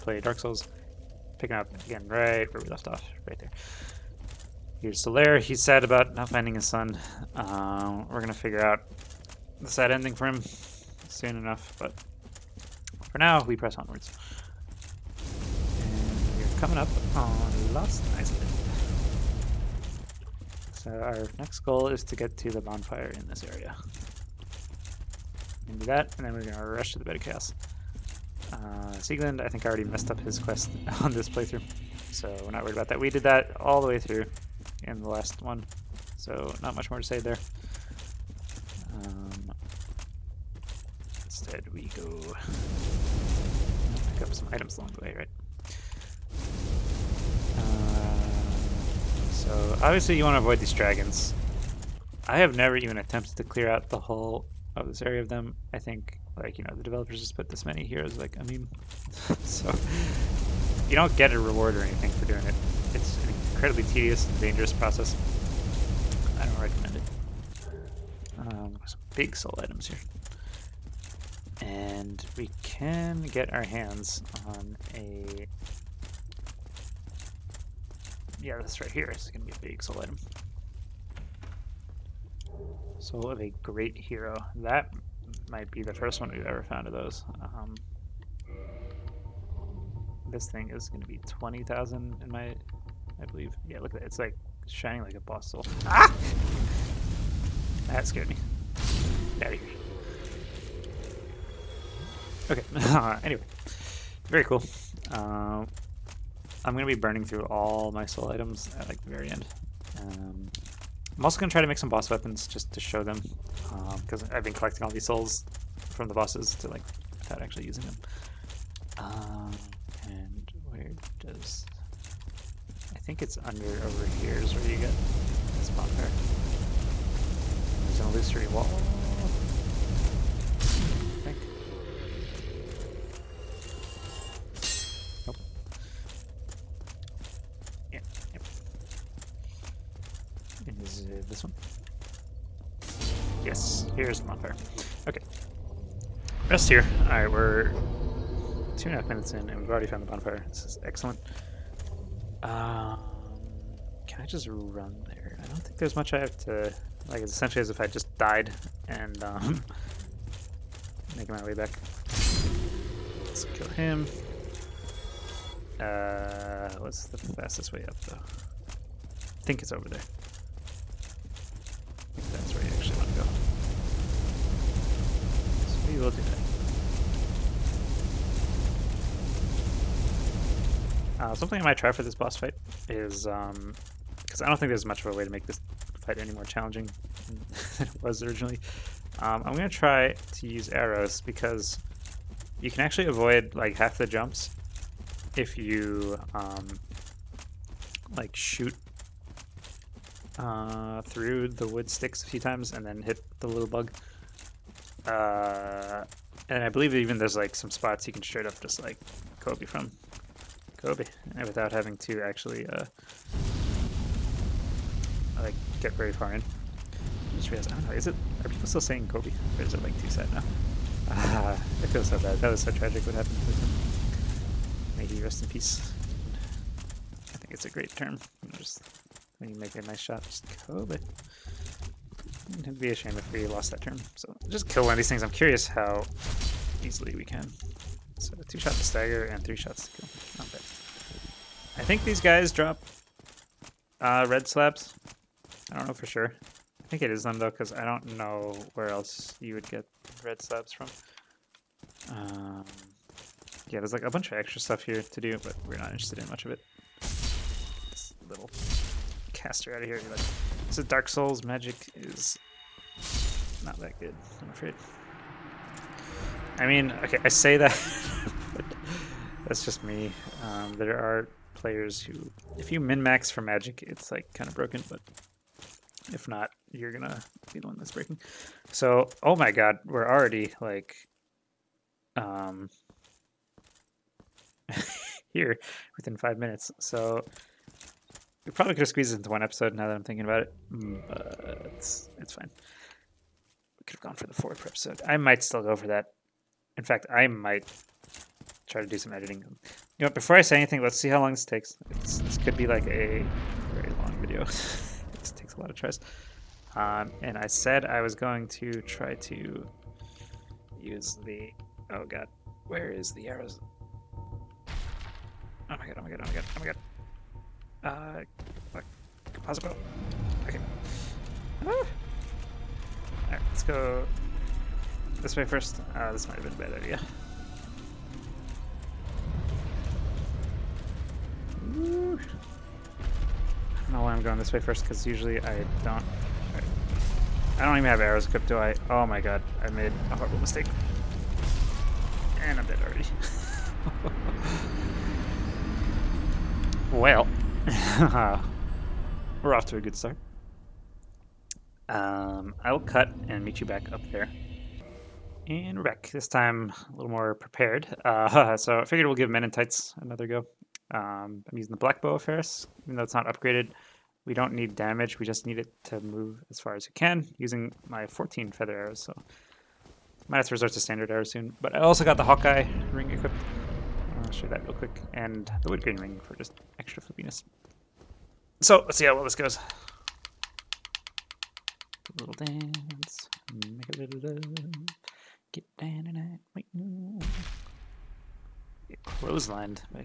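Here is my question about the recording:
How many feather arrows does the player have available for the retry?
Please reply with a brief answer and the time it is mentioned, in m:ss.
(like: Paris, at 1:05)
14, at 6:08.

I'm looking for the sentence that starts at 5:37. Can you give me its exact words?
I don't even have arrows equipped, do I?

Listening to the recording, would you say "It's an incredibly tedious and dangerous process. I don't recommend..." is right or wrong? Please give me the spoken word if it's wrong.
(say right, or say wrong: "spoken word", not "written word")
right.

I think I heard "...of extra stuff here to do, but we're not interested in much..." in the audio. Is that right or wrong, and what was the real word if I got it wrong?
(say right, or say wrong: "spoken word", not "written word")
right.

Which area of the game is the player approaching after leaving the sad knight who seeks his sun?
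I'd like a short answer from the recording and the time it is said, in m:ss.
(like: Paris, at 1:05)
Lost Izalith, at 0:17.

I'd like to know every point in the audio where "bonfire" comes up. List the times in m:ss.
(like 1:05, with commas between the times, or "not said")
0:22, 2:05, 2:24, 2:30.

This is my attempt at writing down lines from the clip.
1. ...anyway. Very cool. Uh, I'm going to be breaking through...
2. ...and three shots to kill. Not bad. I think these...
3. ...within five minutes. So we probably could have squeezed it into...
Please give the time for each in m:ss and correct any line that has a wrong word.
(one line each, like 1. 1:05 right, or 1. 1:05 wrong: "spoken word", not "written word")
1. 1:43 wrong: "burning", not "breaking"
2. 3:59 right
3. 4:45 right.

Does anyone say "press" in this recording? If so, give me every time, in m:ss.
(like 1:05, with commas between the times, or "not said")
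0:13.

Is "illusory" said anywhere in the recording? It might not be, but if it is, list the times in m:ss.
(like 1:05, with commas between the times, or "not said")
2:08.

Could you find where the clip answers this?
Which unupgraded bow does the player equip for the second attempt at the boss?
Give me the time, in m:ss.
6:01.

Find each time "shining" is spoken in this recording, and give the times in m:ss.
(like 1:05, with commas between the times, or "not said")
1:34.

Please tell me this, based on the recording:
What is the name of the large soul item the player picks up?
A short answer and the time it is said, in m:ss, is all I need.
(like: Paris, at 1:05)
Soul of a great hero, at 1:22.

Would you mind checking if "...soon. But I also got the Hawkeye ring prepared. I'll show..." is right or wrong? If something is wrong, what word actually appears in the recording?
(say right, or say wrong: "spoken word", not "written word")
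wrong: "equipped", not "prepared".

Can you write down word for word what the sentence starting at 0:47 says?
Uh, so, obviously, you want to avoid these dragons.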